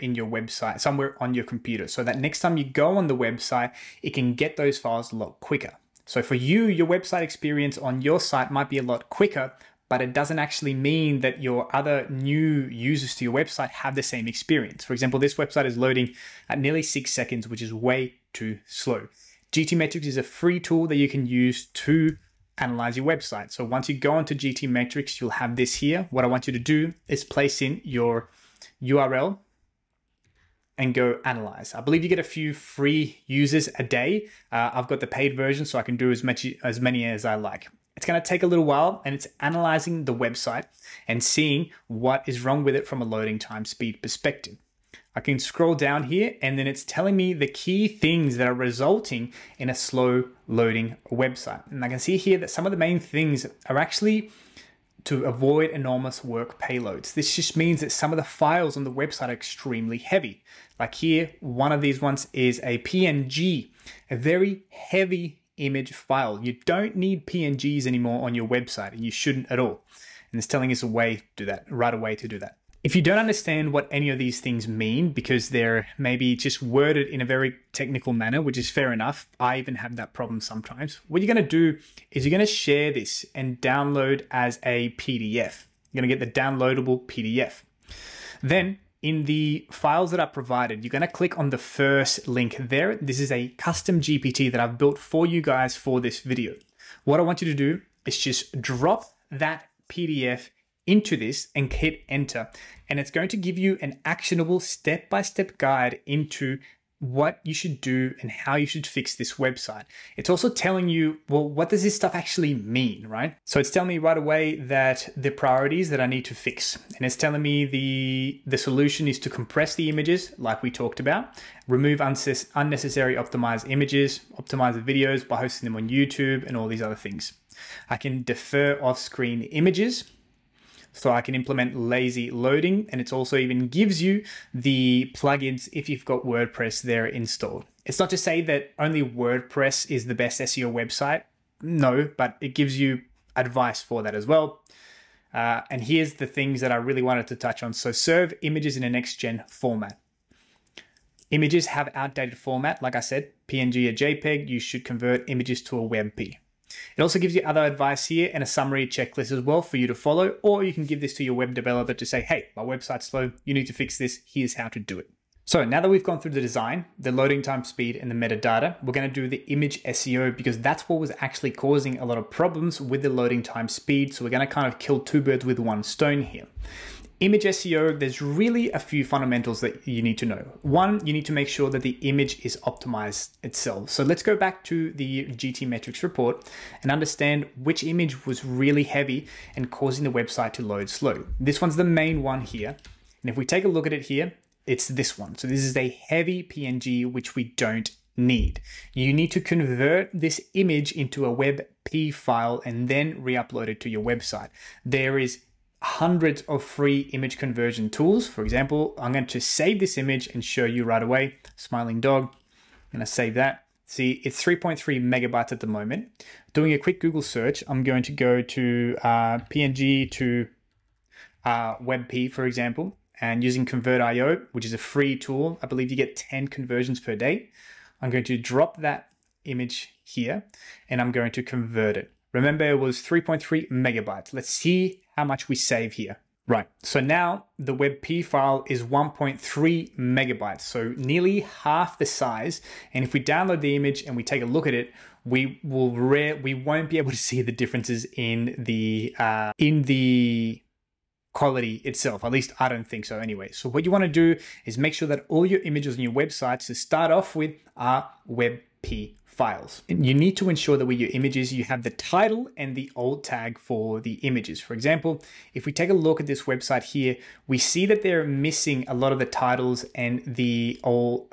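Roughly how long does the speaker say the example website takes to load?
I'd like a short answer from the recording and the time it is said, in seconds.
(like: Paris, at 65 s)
6 seconds, at 16 s.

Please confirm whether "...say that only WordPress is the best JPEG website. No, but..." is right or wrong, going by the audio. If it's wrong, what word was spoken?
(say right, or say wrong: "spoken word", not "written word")
wrong: "SEO", not "JPEG".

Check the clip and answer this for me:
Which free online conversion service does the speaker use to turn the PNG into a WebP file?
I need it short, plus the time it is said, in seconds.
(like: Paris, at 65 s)
Convertio, at 223 s.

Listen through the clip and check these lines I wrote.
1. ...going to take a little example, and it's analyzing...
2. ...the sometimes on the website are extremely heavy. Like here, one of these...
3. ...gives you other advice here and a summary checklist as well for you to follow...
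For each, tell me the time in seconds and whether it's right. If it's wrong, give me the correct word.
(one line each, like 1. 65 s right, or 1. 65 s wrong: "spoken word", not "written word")
1. 38 s wrong: "while", not "example"
2. 58 s wrong: "files", not "sometimes"
3. 157 s right.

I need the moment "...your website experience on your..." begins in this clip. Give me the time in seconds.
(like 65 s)
6 s.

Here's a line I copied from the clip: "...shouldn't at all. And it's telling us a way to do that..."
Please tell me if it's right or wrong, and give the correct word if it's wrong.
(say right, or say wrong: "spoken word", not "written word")
right.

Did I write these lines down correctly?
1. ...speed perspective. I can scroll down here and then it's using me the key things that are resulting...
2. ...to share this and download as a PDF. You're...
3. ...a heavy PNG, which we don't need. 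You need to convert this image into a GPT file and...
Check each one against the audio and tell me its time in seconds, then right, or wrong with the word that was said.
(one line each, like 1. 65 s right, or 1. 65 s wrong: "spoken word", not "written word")
1. 43 s wrong: "telling", not "using"
2. 82 s right
3. 195 s wrong: "WebP", not "GPT".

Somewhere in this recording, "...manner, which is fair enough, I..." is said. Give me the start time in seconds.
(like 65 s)
78 s.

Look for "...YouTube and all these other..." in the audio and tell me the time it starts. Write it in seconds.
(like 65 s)
125 s.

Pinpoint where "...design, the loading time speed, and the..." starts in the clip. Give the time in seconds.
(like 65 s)
166 s.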